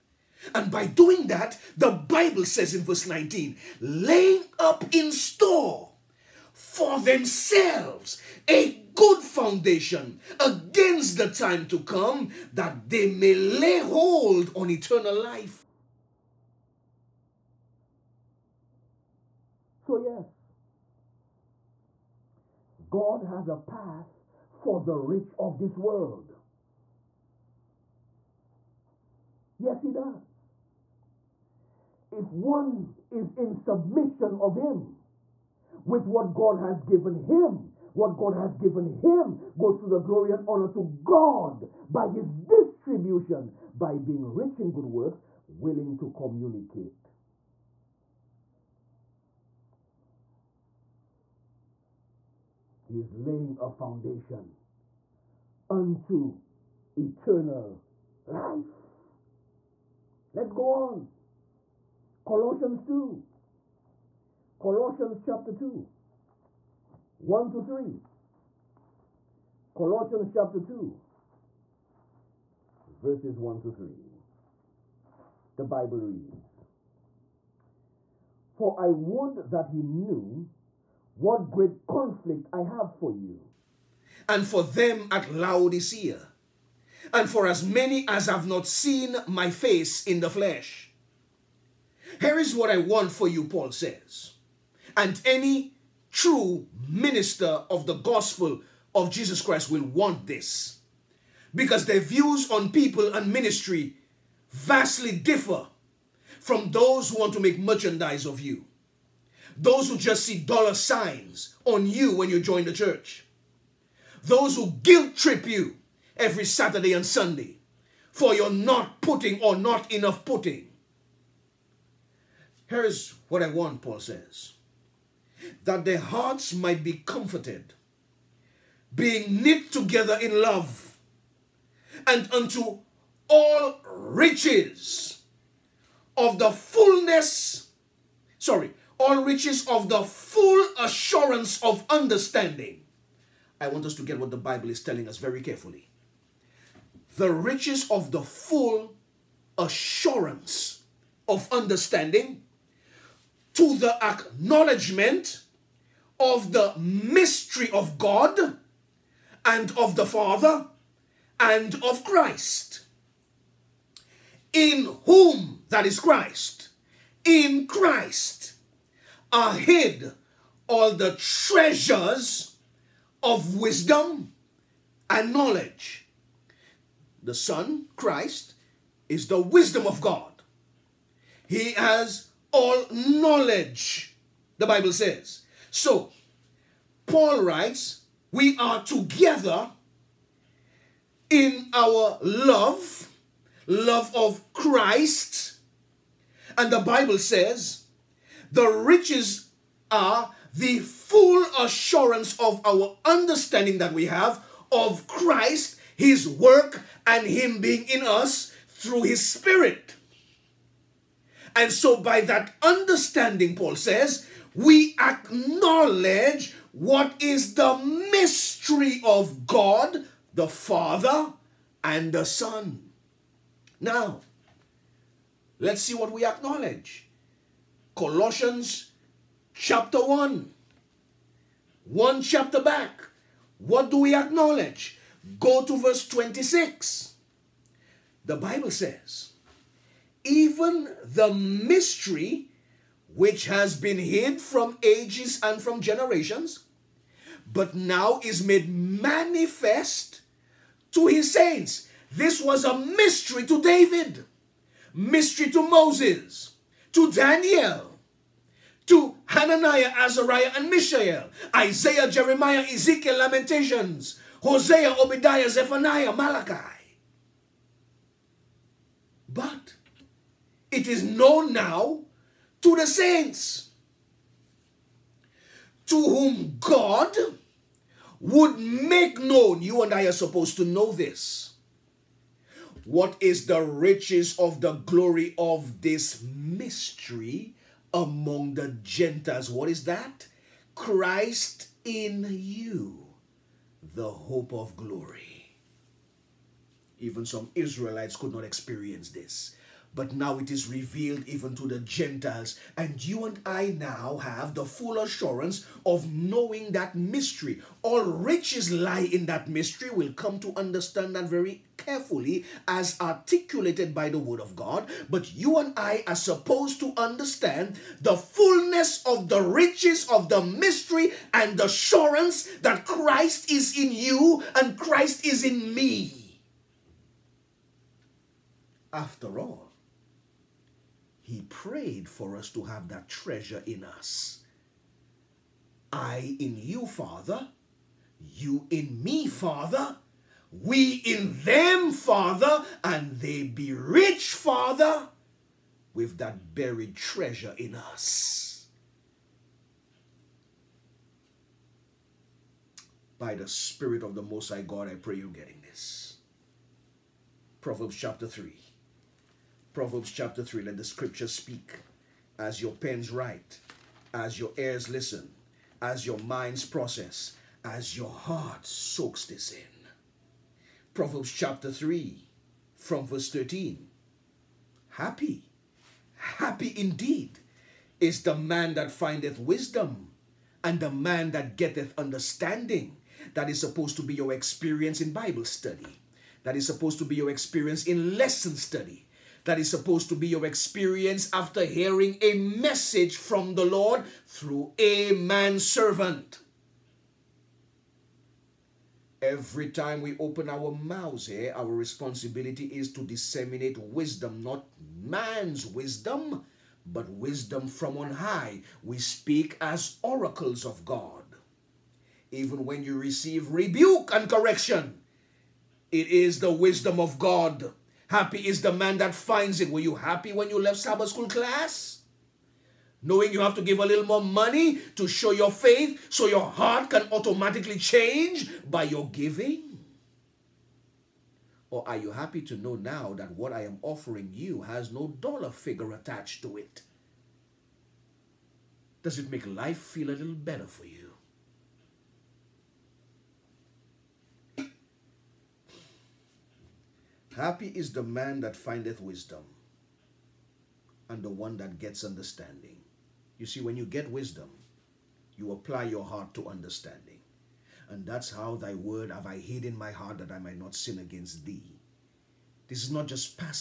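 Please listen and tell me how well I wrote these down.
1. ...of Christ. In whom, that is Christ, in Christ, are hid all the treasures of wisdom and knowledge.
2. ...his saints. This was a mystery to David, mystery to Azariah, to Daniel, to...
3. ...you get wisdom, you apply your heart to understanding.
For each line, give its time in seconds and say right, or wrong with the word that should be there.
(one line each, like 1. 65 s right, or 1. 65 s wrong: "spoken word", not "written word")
1. 161 s right
2. 251 s wrong: "Moses", not "Azariah"
3. 453 s right.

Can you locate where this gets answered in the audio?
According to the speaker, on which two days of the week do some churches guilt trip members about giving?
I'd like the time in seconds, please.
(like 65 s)
116 s.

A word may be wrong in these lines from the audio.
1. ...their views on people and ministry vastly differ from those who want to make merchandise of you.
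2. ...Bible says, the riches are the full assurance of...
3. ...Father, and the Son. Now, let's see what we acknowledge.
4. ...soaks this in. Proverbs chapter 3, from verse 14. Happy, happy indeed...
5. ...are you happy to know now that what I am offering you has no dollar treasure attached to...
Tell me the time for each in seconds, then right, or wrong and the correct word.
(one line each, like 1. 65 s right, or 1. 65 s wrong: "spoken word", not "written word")
1. 101 s right
2. 196 s right
3. 220 s right
4. 368 s wrong: "13", not "14"
5. 431 s wrong: "figure", not "treasure".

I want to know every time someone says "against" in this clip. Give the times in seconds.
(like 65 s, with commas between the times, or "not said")
10 s, 460 s.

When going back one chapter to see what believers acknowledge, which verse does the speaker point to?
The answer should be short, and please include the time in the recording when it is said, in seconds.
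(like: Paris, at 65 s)
26, at 235 s.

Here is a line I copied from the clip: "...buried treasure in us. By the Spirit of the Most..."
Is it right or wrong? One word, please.
right.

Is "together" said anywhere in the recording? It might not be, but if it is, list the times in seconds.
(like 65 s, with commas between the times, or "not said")
129 s, 188 s.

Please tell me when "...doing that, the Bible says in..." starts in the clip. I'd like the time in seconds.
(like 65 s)
0 s.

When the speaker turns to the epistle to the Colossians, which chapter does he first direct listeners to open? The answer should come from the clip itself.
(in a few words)
Colossians 2.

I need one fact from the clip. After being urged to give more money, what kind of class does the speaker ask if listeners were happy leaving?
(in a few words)
Sabbath school.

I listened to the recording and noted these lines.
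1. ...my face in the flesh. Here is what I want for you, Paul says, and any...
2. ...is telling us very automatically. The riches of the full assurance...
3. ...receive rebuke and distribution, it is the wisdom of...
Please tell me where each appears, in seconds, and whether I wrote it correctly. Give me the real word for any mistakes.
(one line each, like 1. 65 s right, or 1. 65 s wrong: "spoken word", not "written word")
1. 89 s right
2. 144 s wrong: "carefully", not "automatically"
3. 412 s wrong: "correction", not "distribution".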